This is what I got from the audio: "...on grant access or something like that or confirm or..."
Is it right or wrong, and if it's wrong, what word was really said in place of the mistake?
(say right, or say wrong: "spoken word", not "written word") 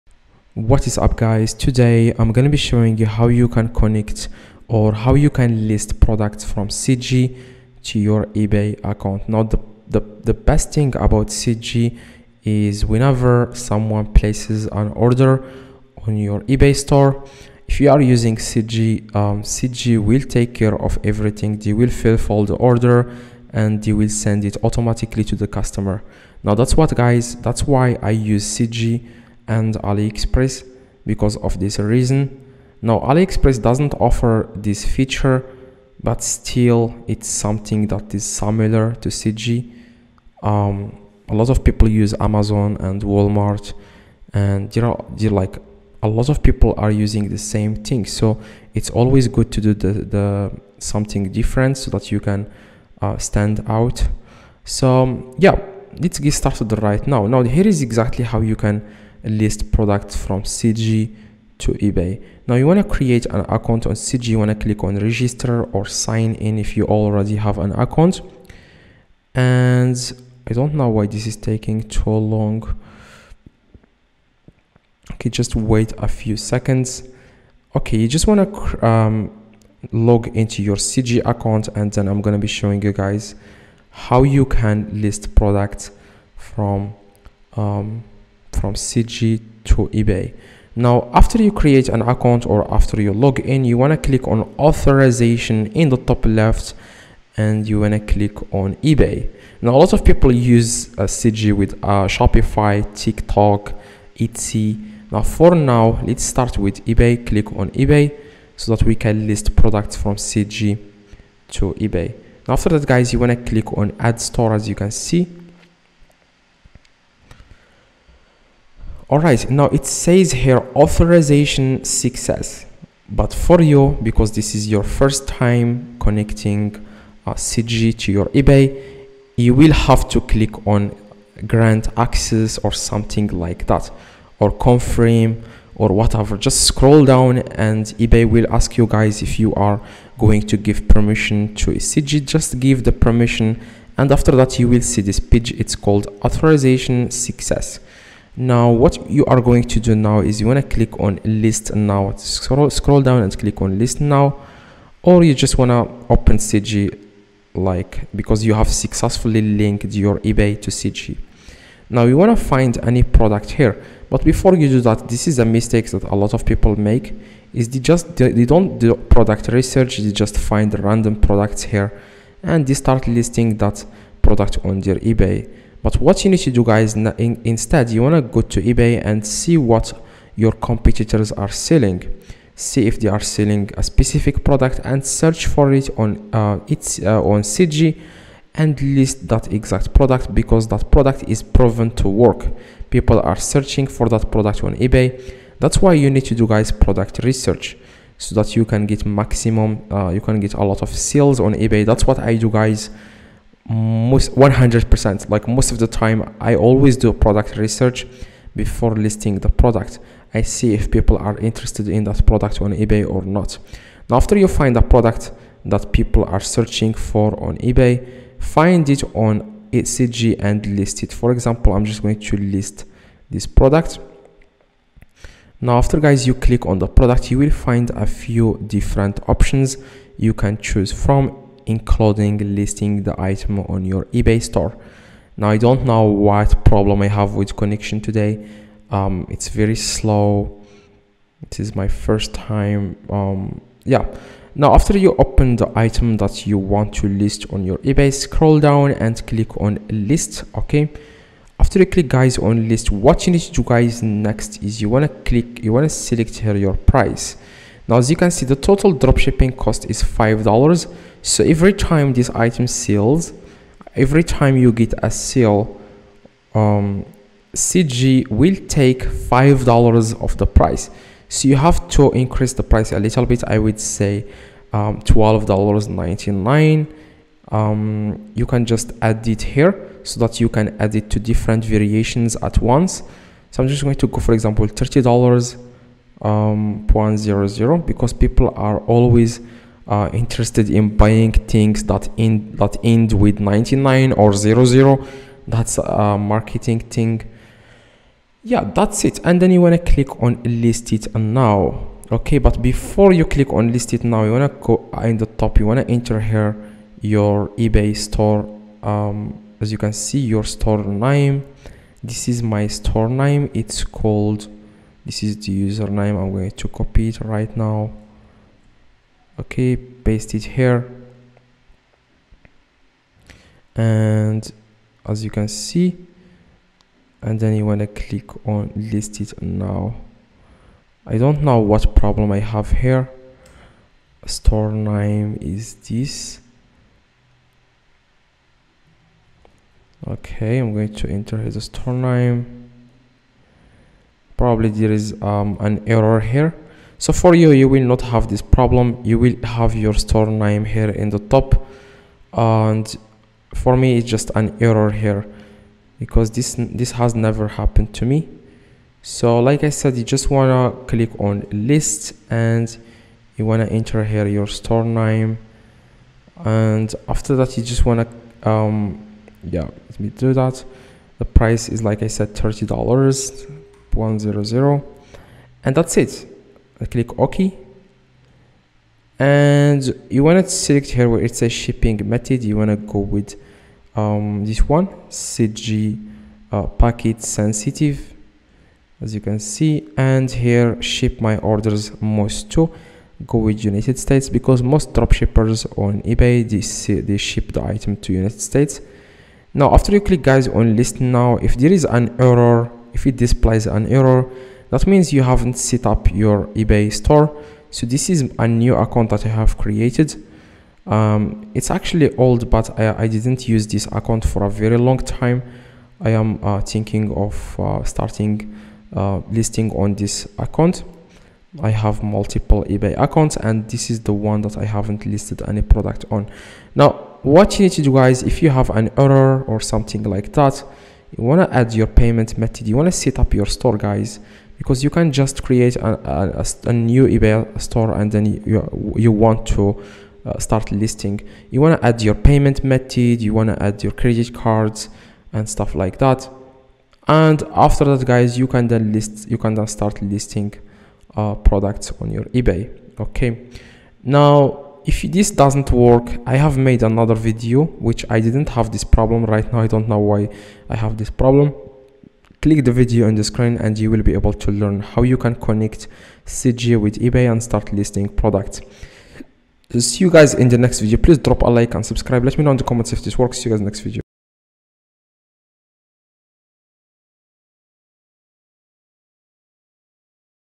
right.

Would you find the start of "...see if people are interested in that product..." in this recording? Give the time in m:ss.
3:30.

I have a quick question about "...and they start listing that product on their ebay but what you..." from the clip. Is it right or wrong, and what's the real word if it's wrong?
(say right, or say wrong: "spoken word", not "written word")
right.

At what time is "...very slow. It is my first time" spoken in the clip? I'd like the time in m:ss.
3:59.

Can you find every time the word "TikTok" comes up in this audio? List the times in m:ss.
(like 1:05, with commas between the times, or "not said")
1:42.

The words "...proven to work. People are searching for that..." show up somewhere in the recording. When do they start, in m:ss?
3:11.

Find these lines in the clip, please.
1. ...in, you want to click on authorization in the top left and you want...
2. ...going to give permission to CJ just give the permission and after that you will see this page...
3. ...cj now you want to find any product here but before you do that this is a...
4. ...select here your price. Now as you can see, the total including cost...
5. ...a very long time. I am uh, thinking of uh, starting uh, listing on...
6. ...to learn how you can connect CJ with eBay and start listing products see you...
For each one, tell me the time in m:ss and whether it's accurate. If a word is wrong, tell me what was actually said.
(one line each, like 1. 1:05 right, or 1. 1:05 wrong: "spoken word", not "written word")
1. 1:33 right
2. 2:20 right
3. 2:40 right
4. 4:15 wrong: "dropshipping", not "including"
5. 6:54 right
6. 7:44 right.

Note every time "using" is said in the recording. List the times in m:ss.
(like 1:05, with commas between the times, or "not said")
0:18, 0:46.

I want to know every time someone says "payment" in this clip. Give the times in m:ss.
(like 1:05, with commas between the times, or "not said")
7:11, 7:22.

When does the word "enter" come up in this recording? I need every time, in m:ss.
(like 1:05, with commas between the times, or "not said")
5:05, 5:41, 6:03.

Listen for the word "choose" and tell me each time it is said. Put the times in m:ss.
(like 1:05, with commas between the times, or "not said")
3:50.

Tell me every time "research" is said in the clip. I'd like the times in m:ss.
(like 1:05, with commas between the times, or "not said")
2:49, 3:17, 3:27.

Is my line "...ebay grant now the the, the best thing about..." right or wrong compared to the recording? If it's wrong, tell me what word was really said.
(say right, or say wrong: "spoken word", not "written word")
wrong: "account", not "grant".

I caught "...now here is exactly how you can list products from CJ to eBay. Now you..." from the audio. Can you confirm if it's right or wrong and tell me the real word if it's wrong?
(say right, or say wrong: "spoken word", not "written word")
right.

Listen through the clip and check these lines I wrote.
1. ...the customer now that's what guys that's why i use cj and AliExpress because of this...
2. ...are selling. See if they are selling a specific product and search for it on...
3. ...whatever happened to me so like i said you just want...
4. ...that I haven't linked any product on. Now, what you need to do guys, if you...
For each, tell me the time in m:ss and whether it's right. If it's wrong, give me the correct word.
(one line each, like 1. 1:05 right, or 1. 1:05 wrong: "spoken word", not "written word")
1. 0:25 right
2. 3:01 right
3. 5:57 wrong: "never", not "whatever"
4. 7:04 wrong: "listed", not "linked".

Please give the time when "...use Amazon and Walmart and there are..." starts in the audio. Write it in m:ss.
0:41.